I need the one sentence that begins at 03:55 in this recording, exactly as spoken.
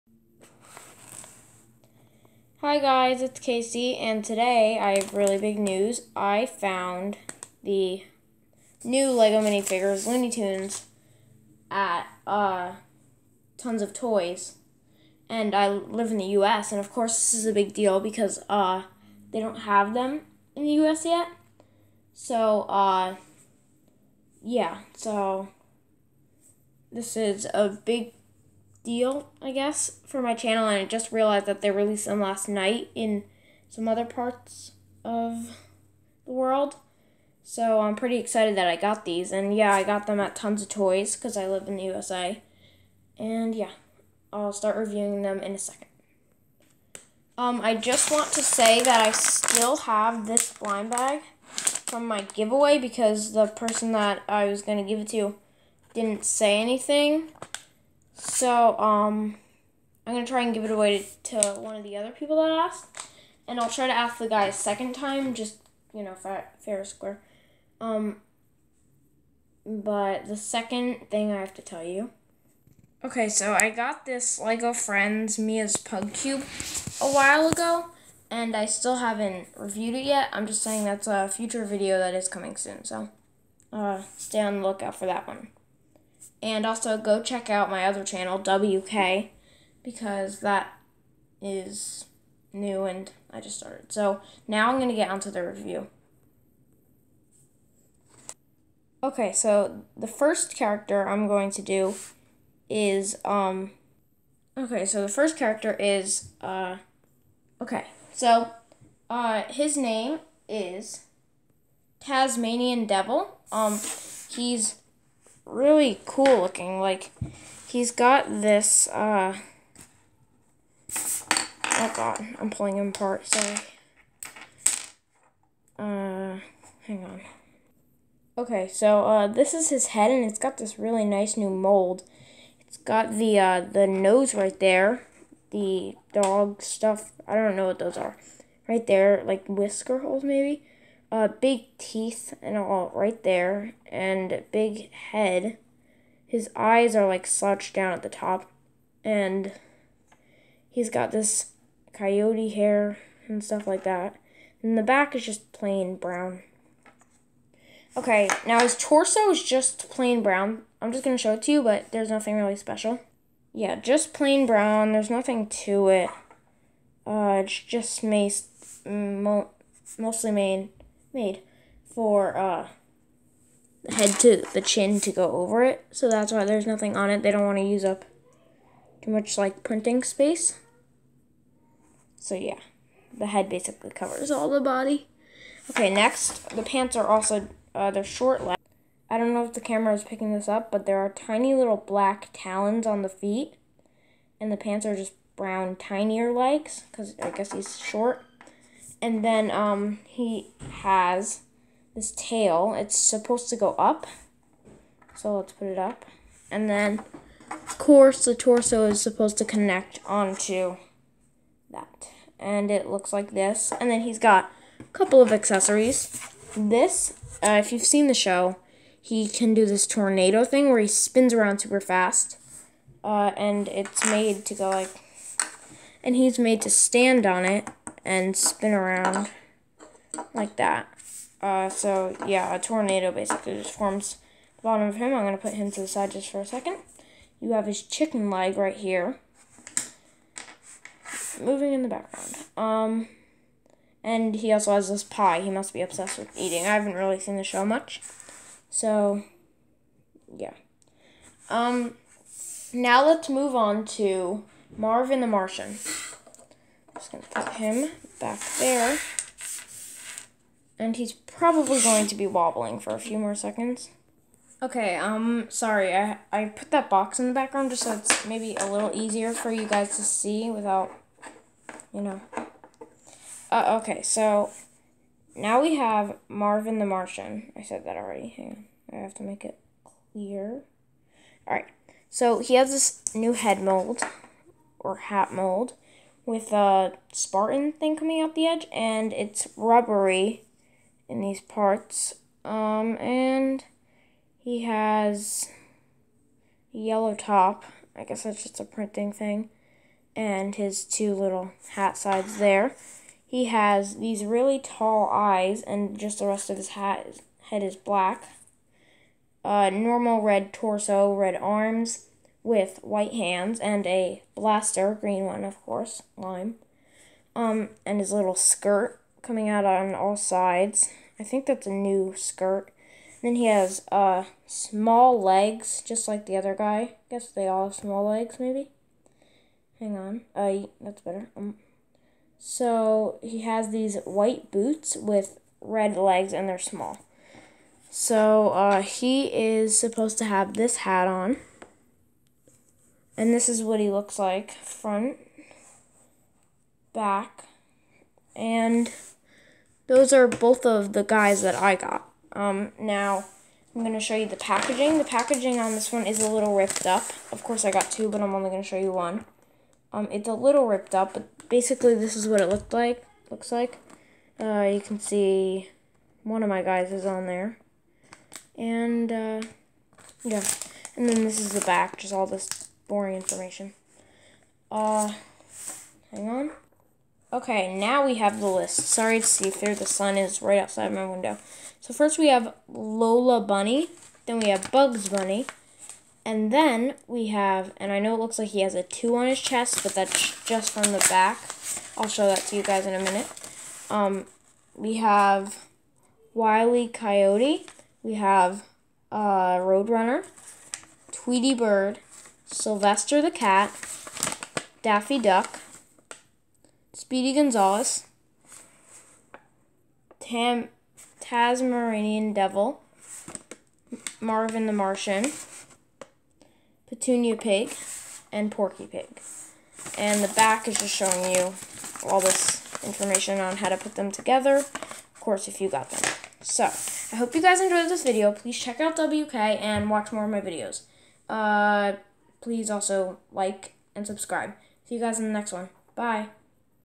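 I'm gonna put him to the side just for a second.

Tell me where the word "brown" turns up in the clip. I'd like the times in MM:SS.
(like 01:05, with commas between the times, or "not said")
02:35, 02:40, 02:44, 03:15.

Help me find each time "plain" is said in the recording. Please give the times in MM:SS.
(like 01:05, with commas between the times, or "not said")
02:35, 02:39, 02:44.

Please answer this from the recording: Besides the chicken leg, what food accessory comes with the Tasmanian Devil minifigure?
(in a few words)
pie.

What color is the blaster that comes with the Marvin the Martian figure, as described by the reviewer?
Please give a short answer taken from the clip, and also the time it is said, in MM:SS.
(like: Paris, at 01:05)
lime, at 05:16.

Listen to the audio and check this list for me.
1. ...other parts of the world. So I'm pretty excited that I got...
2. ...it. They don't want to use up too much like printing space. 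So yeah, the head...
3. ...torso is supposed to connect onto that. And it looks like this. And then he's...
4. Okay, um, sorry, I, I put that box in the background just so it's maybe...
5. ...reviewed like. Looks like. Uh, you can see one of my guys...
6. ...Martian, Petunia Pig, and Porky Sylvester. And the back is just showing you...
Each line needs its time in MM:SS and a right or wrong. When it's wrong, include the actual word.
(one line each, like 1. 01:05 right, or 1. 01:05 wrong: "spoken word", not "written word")
1. 00:33 right
2. 02:57 right
3. 03:28 right
4. 04:24 right
5. 06:02 wrong: "looked", not "reviewed"
6. 06:54 wrong: "Pig", not "Sylvester".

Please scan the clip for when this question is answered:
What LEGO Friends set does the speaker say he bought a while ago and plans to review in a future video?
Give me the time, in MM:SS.
01:15.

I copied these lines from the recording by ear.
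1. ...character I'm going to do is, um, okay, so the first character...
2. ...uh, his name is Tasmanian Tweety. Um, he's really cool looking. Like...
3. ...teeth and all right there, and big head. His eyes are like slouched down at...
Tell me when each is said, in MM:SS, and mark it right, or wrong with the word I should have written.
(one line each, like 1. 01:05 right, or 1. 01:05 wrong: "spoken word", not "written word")
1. 01:40 right
2. 01:49 wrong: "Devil", not "Tweety"
3. 02:21 right.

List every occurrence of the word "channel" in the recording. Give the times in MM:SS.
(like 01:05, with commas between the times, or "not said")
00:30, 01:28.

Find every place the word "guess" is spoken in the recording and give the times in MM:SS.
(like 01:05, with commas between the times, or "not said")
00:29, 03:17, 04:58, 05:27.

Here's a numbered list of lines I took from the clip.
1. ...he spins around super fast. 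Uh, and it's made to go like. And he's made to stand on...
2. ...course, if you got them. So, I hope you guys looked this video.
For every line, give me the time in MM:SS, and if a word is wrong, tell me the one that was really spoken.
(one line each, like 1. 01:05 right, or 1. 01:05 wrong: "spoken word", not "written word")
1. 03:40 right
2. 07:05 wrong: "enjoyed", not "looked".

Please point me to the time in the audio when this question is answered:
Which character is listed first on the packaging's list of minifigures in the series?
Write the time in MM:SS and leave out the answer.
06:22.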